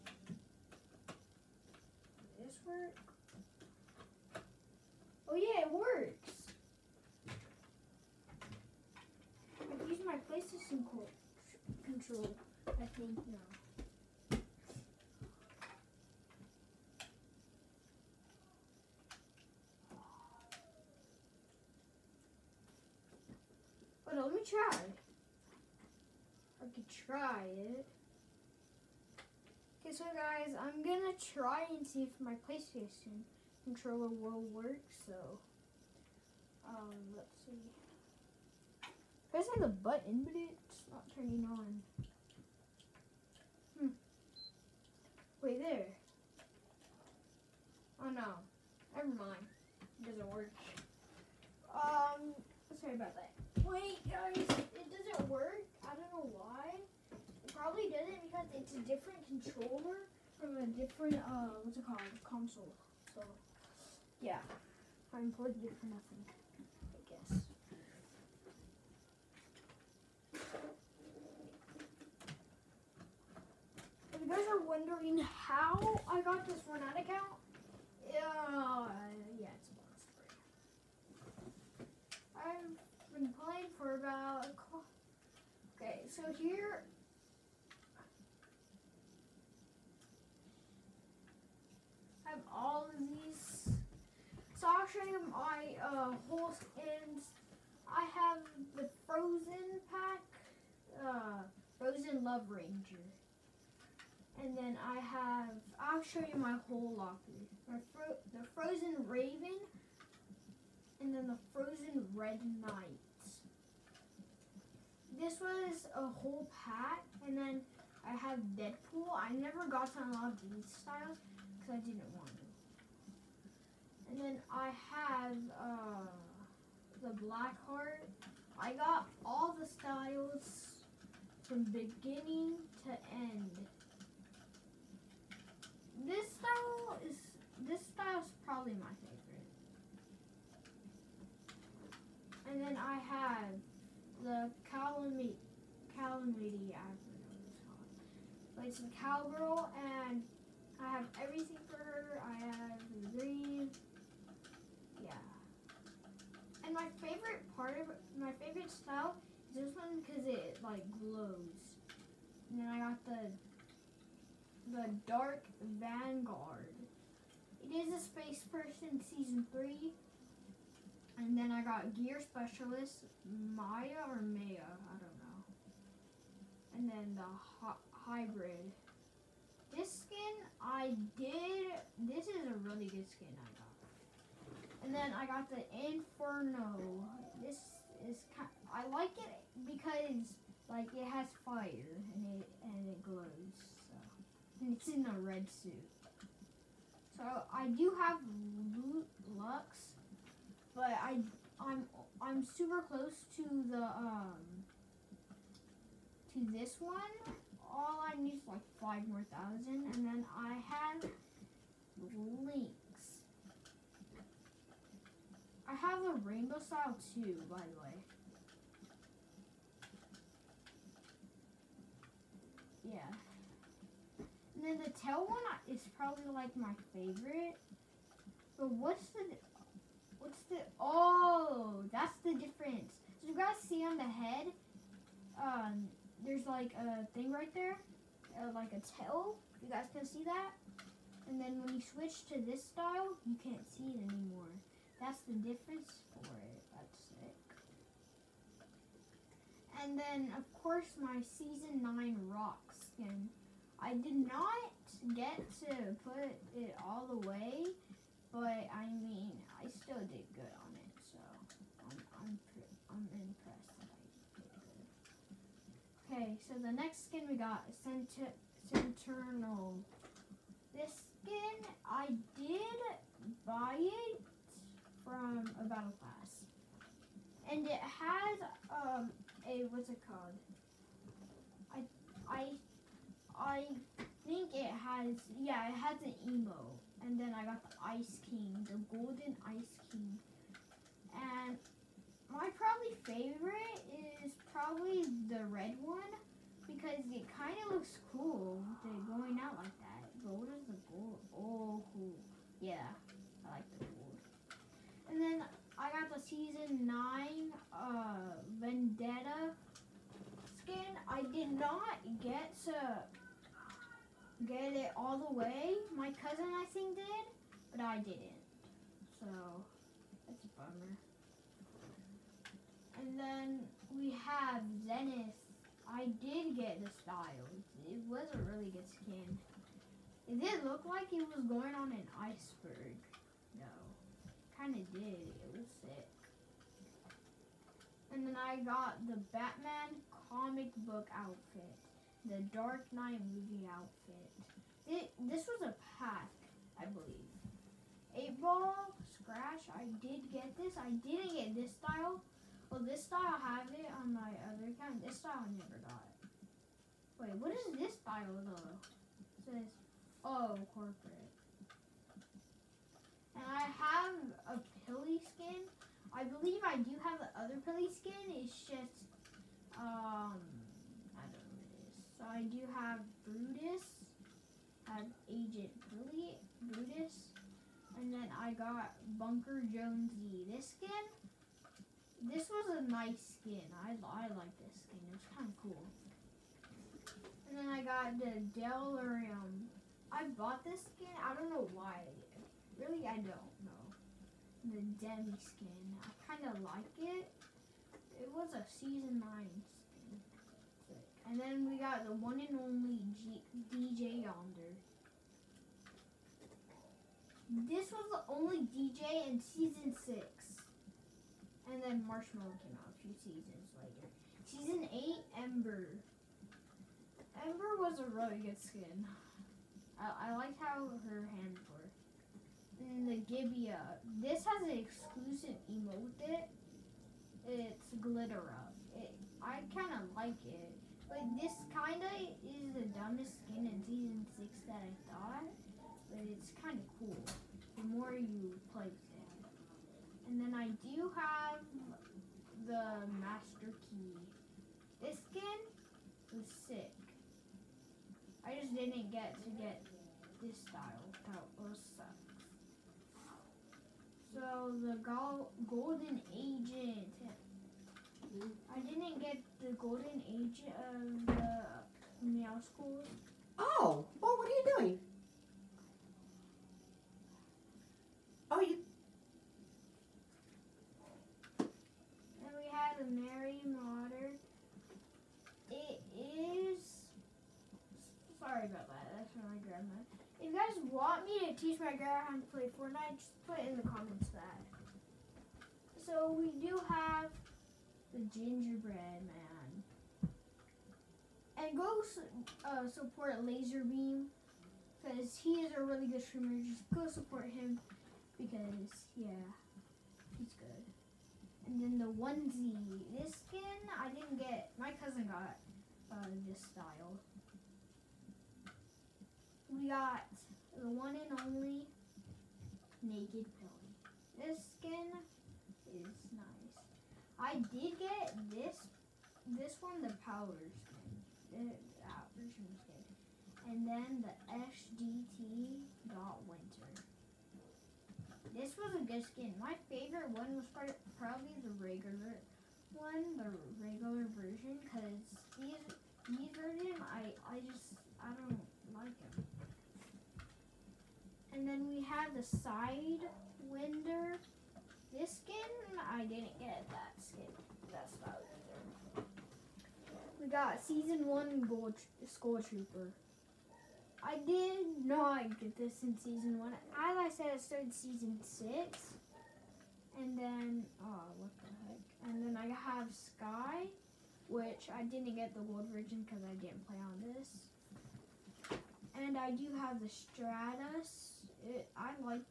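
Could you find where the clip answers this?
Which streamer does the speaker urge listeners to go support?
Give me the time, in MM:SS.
08:13.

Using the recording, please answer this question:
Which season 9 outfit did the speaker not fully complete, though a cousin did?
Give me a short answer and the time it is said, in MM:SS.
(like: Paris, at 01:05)
Vendetta, at 05:08.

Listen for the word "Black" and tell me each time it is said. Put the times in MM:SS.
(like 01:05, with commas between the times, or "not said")
02:07.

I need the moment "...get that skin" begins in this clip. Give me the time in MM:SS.
09:06.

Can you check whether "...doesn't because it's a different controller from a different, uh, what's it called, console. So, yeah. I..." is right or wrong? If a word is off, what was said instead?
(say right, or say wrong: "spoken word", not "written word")
right.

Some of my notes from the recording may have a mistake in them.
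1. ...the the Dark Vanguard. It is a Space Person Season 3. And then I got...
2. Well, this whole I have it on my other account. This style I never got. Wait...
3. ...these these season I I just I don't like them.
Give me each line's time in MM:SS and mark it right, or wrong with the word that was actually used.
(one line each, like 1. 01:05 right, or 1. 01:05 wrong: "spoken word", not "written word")
1. 02:43 right
2. 05:52 wrong: "style", not "whole"
3. 08:55 wrong: "version", not "season".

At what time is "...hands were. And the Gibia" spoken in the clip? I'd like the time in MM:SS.
07:01.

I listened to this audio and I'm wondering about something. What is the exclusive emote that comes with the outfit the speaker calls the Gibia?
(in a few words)
Glitter up.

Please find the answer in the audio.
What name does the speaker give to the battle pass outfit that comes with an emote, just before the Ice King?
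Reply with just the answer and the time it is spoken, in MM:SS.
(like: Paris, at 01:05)
Centurnal, at 04:28.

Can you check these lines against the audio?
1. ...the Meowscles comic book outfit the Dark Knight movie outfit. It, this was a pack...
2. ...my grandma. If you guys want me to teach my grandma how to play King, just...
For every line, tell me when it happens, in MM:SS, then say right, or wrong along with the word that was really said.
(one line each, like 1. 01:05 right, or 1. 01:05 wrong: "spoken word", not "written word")
1. 05:39 wrong: "Batman", not "Meowscles"
2. 07:59 wrong: "Fortnite", not "King".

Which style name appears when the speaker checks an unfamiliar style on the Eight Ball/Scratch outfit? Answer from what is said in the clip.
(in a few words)
corporate.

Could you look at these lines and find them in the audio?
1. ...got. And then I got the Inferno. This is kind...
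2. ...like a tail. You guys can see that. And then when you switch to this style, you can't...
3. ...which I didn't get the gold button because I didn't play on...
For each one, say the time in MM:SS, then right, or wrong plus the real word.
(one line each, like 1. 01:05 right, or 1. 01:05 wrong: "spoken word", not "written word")
1. 03:03 right
2. 03:58 right
3. 09:24 wrong: "version", not "button".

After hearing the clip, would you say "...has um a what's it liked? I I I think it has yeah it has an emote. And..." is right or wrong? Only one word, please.
wrong.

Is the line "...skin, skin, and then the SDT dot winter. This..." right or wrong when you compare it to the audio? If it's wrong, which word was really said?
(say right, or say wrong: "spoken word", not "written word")
right.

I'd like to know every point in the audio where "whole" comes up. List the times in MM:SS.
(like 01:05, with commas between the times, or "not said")
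01:36, 01:46, 01:56.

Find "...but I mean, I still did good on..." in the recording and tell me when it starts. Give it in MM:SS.
04:18.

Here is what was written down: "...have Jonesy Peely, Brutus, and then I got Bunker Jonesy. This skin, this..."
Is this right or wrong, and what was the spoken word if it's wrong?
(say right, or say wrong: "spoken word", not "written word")
wrong: "Agent", not "Jonesy".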